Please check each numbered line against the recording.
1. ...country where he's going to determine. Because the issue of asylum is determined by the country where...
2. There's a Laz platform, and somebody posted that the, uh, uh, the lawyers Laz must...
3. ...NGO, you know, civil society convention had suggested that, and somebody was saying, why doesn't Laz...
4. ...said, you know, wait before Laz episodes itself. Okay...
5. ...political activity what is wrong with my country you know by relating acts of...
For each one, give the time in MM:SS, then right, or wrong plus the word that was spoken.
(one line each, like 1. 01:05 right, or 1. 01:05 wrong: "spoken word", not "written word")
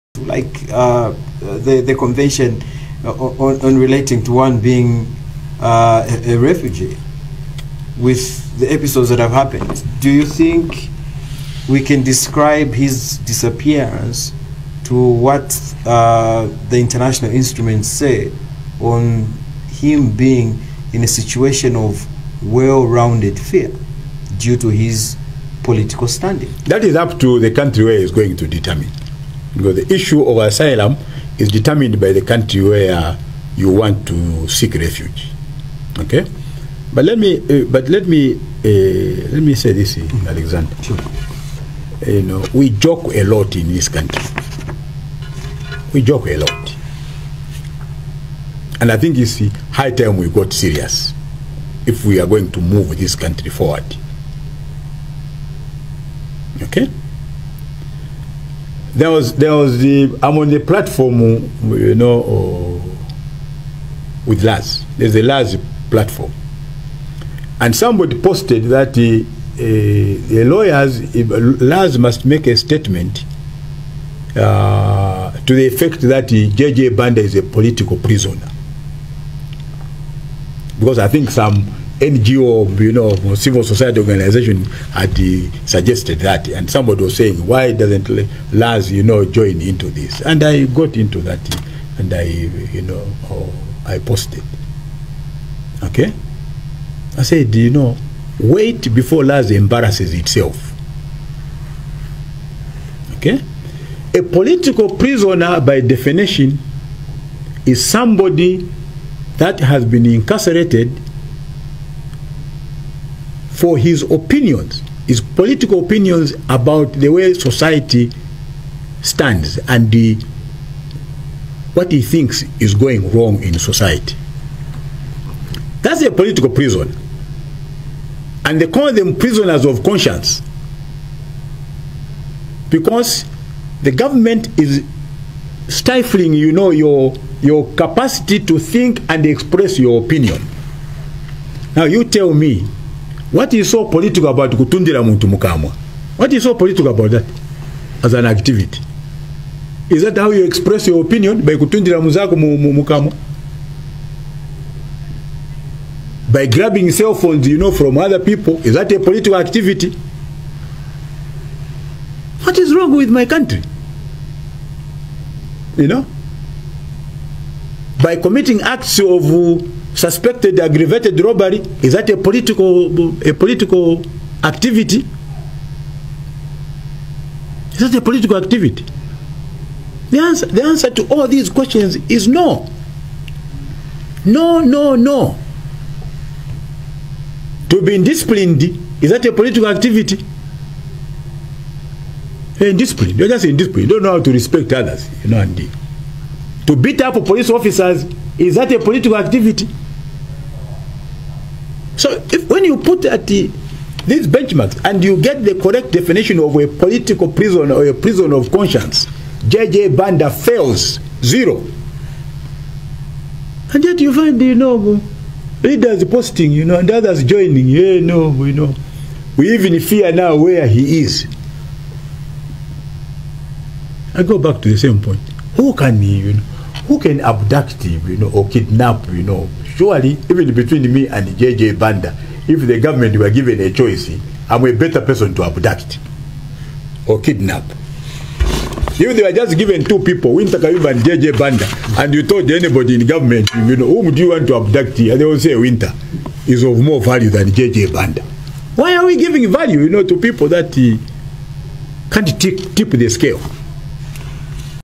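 1. 00:27 right
2. 01:04 right
3. 01:22 wrong: "organization", not "convention"
4. 01:37 wrong: "embarrasses", not "episodes"
5. 02:38 wrong: "committing", not "relating".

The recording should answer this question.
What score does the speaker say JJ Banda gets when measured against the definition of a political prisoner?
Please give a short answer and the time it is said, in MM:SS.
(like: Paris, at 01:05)
0, at 03:31.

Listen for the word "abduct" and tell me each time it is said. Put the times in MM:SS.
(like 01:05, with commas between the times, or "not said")
03:47, 03:55, 04:04.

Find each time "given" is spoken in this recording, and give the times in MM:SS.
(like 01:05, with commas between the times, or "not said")
03:53, 03:59.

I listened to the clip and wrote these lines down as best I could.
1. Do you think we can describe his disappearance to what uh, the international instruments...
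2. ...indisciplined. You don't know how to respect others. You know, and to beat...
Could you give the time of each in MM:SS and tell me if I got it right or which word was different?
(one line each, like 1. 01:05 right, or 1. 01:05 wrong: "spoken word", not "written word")
1. 00:09 right
2. 03:13 right.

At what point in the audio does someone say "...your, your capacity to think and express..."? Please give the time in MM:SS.
02:16.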